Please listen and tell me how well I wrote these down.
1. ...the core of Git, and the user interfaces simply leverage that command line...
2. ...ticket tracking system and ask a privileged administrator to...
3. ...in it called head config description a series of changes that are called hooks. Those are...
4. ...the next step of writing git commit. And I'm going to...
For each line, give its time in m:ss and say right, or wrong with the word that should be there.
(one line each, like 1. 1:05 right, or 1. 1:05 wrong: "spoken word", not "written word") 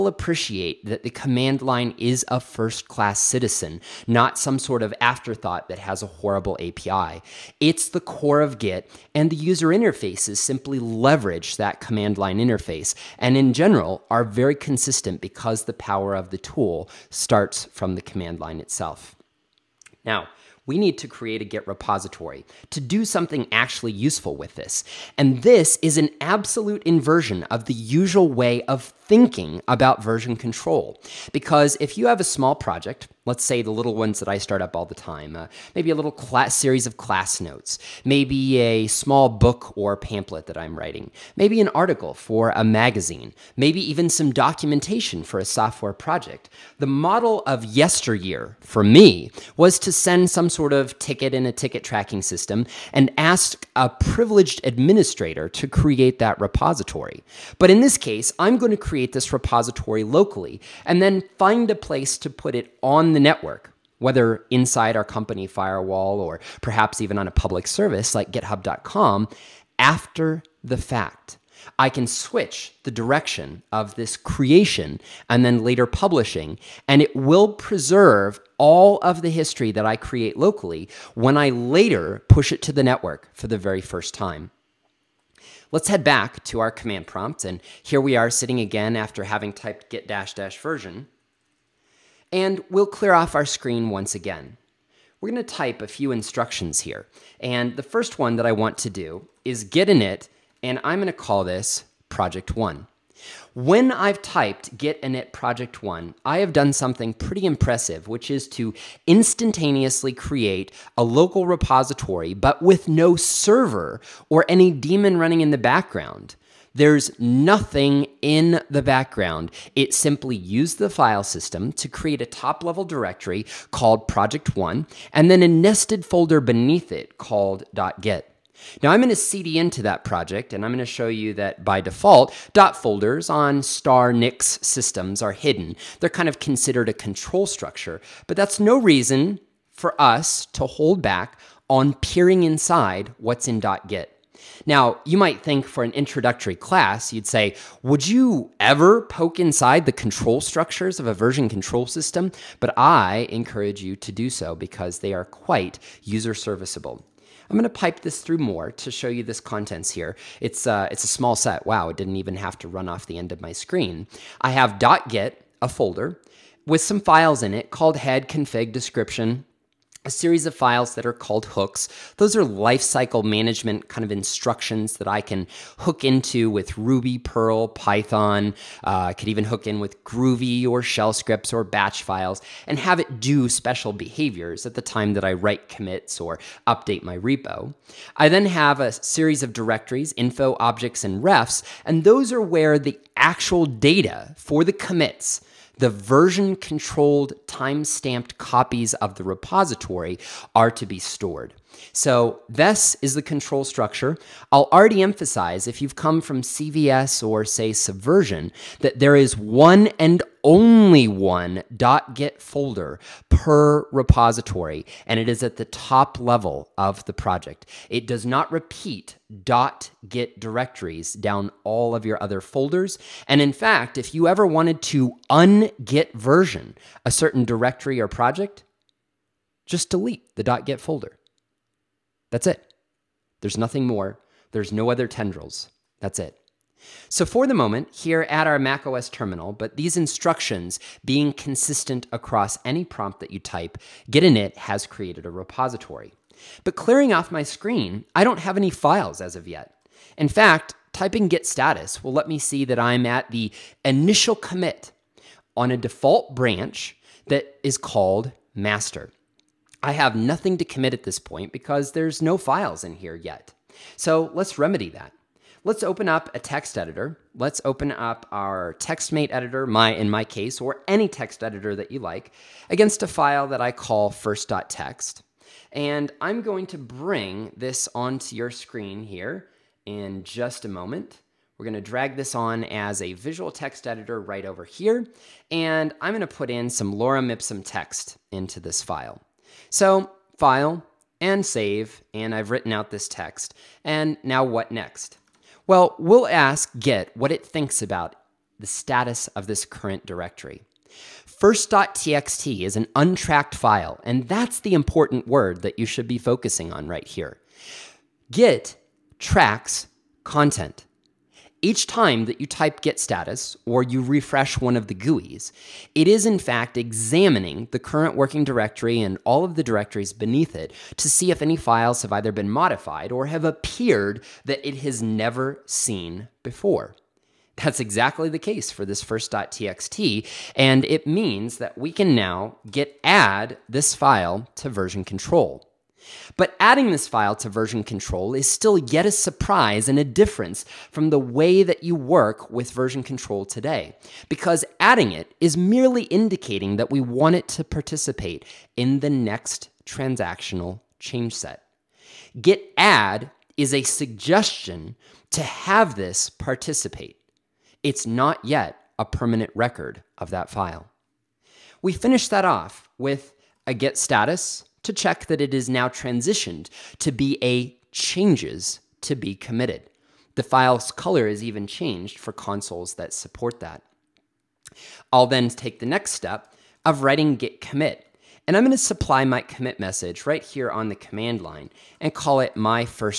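1. 0:07 right
2. 0:51 right
3. 2:47 wrong: "files", not "changes"
4. 6:15 right.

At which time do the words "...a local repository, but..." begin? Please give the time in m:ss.
1:50.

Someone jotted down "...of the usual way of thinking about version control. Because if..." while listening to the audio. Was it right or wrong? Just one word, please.
right.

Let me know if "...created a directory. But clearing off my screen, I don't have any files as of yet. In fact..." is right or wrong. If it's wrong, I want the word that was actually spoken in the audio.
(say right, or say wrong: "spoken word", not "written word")
wrong: "repository", not "directory".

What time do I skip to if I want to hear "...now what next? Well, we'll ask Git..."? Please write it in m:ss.
4:54.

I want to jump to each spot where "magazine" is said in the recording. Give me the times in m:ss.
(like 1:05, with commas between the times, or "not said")
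0:42.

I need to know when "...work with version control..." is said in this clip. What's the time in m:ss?
5:41.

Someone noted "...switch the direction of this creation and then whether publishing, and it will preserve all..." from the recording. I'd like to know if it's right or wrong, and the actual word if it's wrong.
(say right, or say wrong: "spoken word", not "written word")
wrong: "later", not "whether".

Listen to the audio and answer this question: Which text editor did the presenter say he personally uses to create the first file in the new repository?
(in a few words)
TextMate.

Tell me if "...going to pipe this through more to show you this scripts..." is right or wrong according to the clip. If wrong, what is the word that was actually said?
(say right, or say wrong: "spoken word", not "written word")
wrong: "contents", not "scripts".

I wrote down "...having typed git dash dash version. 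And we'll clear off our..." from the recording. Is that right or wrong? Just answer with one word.
right.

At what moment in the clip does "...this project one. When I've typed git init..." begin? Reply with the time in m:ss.
1:41.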